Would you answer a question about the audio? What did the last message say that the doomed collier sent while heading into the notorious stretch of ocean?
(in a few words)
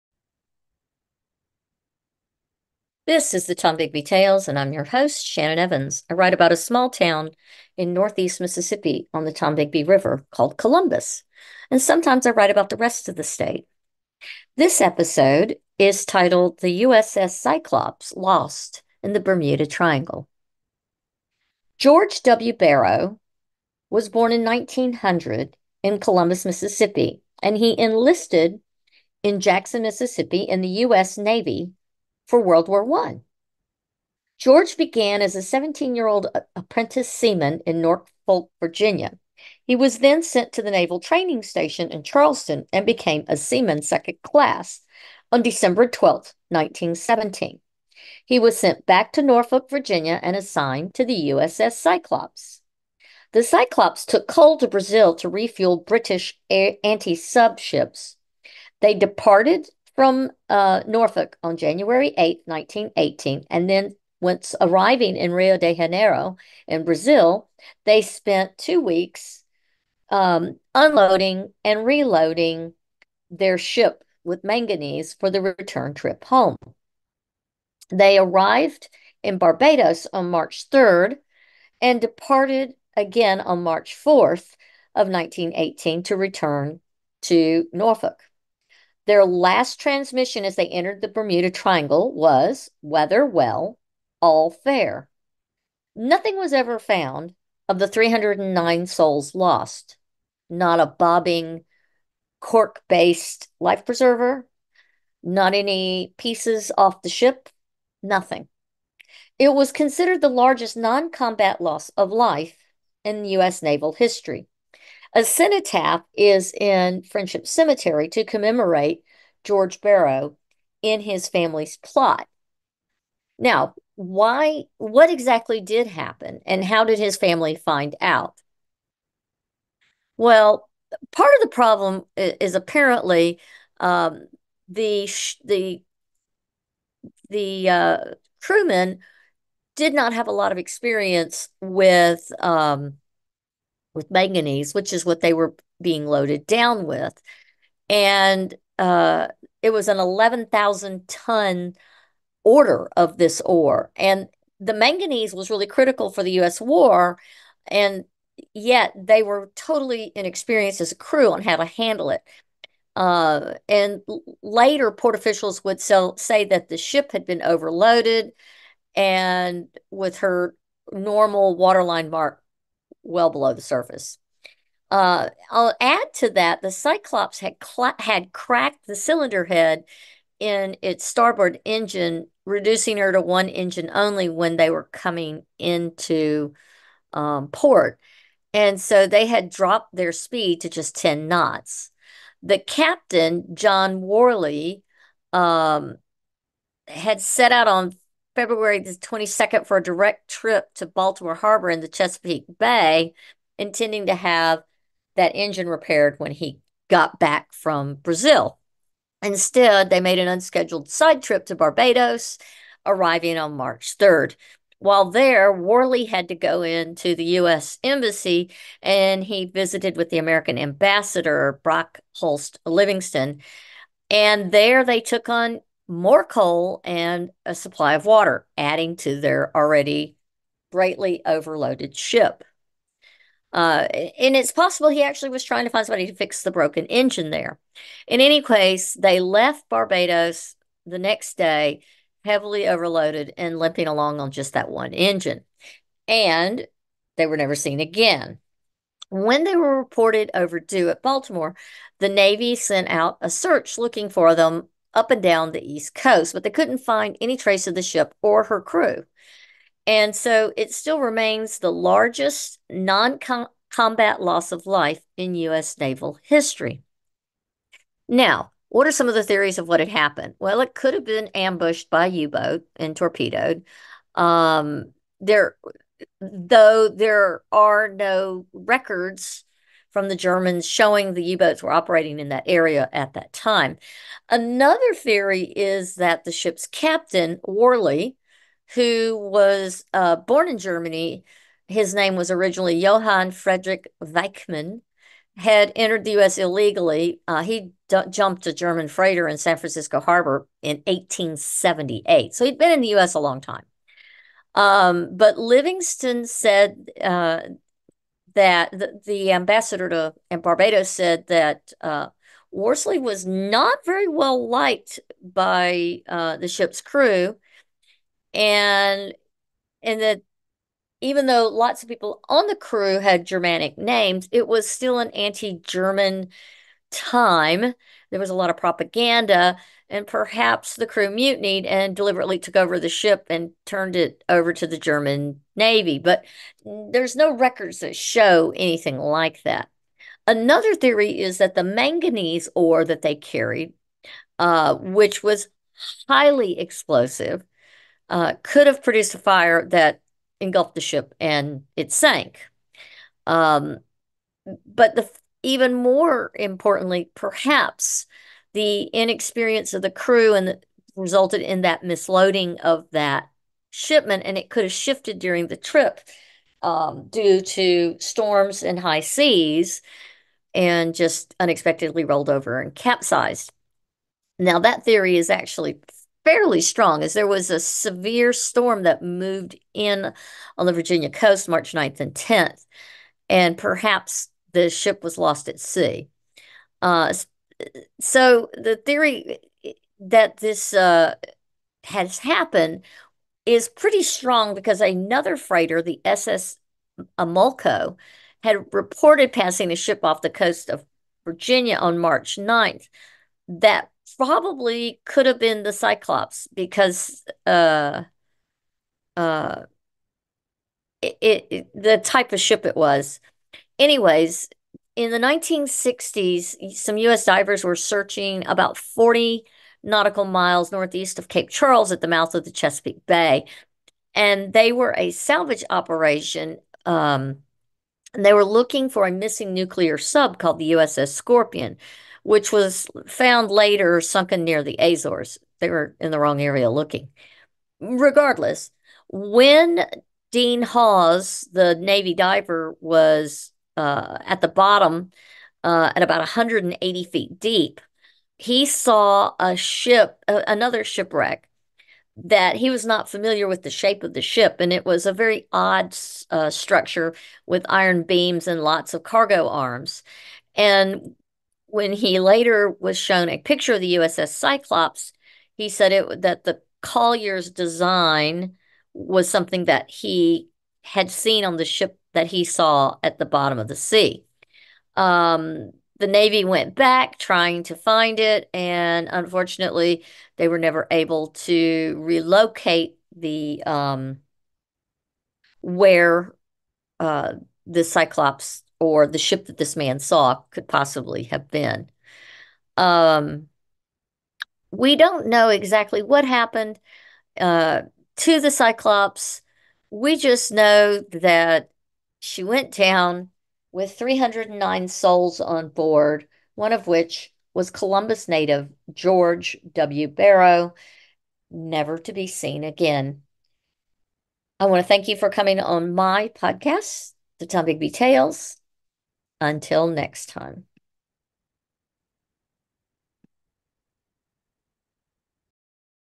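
Weather well, all fair.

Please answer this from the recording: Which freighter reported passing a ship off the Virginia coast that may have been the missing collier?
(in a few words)
SS Amulco.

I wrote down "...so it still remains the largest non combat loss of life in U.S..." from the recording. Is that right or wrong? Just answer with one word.
right.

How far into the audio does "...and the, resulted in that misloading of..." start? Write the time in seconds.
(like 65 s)
360 s.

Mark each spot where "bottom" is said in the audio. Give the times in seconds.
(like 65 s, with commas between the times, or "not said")
444 s, 473 s.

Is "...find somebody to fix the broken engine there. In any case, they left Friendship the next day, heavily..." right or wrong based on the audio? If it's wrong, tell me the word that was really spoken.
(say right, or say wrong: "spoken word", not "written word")
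wrong: "Barbados", not "Friendship".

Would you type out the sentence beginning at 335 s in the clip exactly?
But there's no records that show anything like that.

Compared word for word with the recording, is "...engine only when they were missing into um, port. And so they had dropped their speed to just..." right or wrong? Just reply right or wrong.
wrong.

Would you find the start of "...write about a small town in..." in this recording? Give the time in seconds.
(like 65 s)
6 s.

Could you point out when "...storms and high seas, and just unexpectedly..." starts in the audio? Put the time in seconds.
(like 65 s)
367 s.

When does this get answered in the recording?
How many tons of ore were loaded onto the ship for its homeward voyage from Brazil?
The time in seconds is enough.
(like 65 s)
149 s.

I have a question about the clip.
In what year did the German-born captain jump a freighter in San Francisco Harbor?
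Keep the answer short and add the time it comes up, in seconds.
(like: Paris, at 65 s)
1878, at 300 s.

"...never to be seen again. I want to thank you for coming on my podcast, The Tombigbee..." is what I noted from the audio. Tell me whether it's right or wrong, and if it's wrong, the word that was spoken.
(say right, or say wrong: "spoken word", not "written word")
right.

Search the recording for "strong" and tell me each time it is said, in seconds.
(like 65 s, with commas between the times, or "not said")
376 s, 394 s.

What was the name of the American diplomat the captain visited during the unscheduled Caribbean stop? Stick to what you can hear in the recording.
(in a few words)
Brock Holst Livingston.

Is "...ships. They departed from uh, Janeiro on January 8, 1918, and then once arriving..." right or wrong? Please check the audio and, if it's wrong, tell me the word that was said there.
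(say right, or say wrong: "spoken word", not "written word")
wrong: "Norfolk", not "Janeiro".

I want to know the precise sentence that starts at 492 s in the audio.
Um, we don't know exactly what happened uh, to the Cyclops.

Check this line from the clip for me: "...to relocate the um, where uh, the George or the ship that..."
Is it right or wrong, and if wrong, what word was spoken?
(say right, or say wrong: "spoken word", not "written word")
wrong: "Cyclops", not "George".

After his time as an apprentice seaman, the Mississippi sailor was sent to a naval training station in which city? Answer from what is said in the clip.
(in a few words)
Charleston.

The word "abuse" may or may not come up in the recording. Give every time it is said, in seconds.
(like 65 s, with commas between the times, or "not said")
not said.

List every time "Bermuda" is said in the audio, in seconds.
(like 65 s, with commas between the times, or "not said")
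19 s, 91 s.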